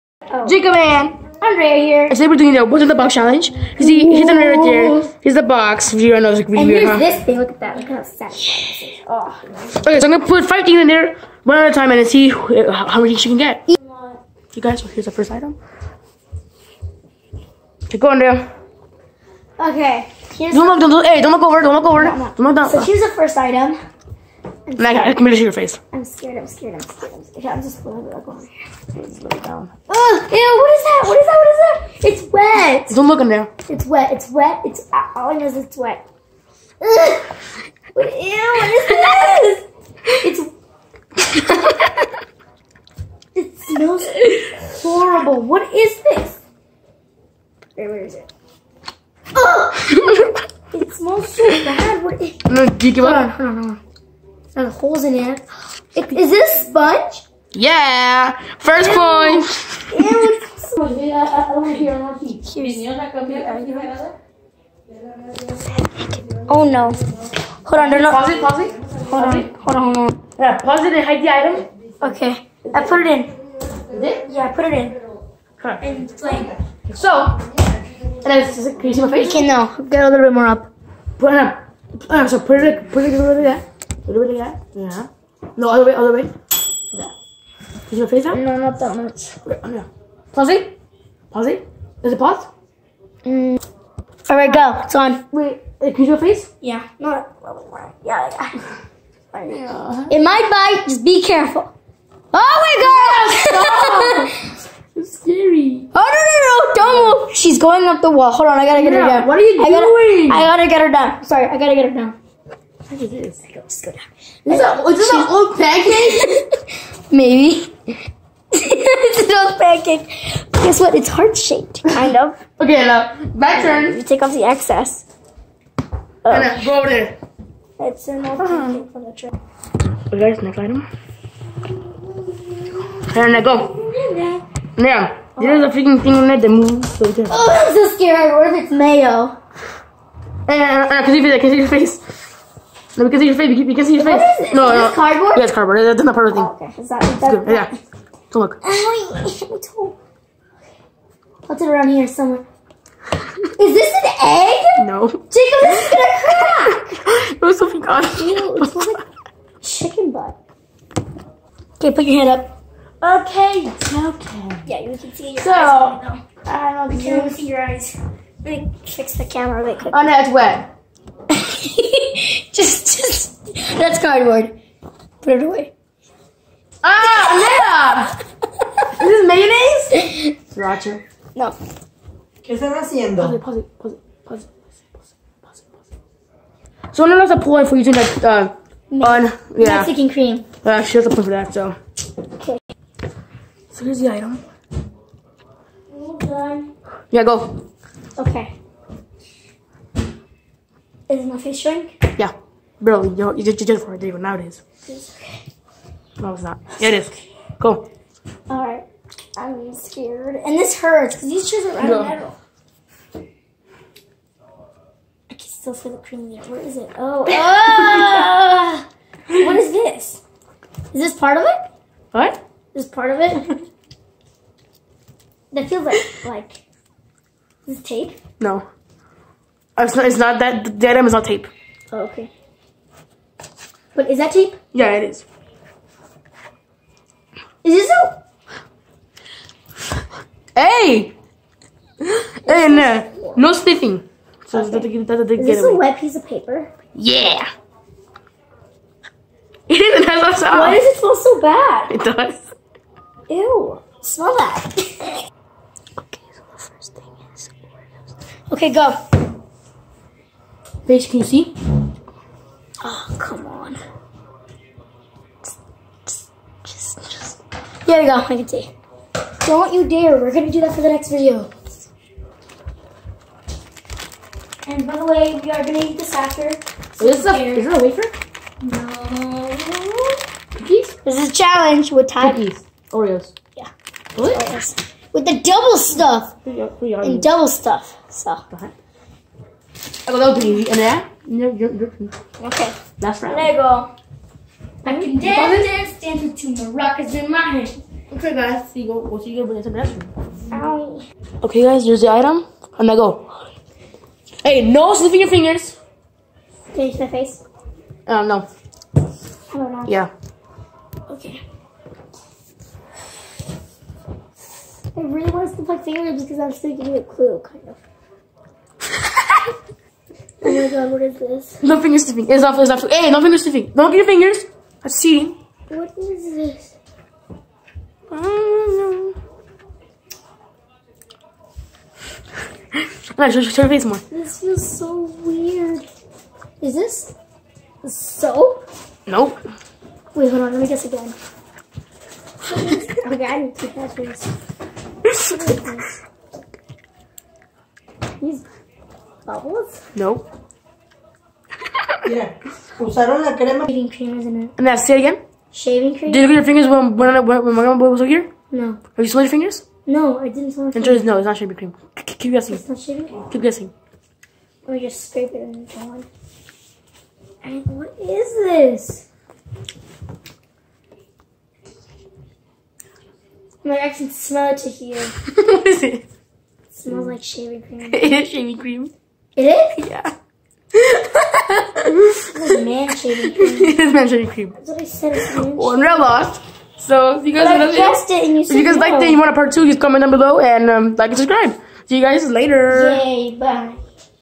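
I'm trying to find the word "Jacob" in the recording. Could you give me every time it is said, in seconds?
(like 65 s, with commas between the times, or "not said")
0 s, 155 s.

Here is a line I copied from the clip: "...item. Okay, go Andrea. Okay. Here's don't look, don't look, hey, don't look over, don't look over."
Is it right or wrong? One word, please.
right.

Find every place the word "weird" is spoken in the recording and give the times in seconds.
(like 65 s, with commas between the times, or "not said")
6 s, 335 s.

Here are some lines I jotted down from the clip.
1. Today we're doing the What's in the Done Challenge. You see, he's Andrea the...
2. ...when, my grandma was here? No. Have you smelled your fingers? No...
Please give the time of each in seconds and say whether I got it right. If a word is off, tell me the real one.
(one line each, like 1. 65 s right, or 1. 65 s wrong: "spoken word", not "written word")
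1. 2 s wrong: "Box", not "Done"
2. 357 s right.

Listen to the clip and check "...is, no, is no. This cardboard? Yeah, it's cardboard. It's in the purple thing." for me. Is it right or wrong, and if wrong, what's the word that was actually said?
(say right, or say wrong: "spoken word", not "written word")
right.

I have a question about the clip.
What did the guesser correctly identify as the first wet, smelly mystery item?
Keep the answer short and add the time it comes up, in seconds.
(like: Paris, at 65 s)
Sponge, at 56 s.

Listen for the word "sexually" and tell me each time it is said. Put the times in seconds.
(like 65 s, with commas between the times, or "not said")
not said.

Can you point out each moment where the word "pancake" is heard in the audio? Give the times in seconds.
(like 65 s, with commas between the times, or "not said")
115 s, 119 s, 128 s.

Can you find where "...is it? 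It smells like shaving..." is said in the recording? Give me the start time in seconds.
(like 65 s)
375 s.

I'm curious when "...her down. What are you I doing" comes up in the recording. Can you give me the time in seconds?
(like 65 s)
109 s.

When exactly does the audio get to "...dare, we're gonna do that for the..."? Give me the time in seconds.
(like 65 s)
269 s.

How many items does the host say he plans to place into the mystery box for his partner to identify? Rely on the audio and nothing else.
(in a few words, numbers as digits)
15.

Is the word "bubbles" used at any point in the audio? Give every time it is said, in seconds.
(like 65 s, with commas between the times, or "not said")
349 s.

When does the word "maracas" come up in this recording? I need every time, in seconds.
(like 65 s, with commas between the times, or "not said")
296 s.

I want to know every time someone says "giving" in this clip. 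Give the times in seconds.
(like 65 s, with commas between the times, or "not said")
316 s.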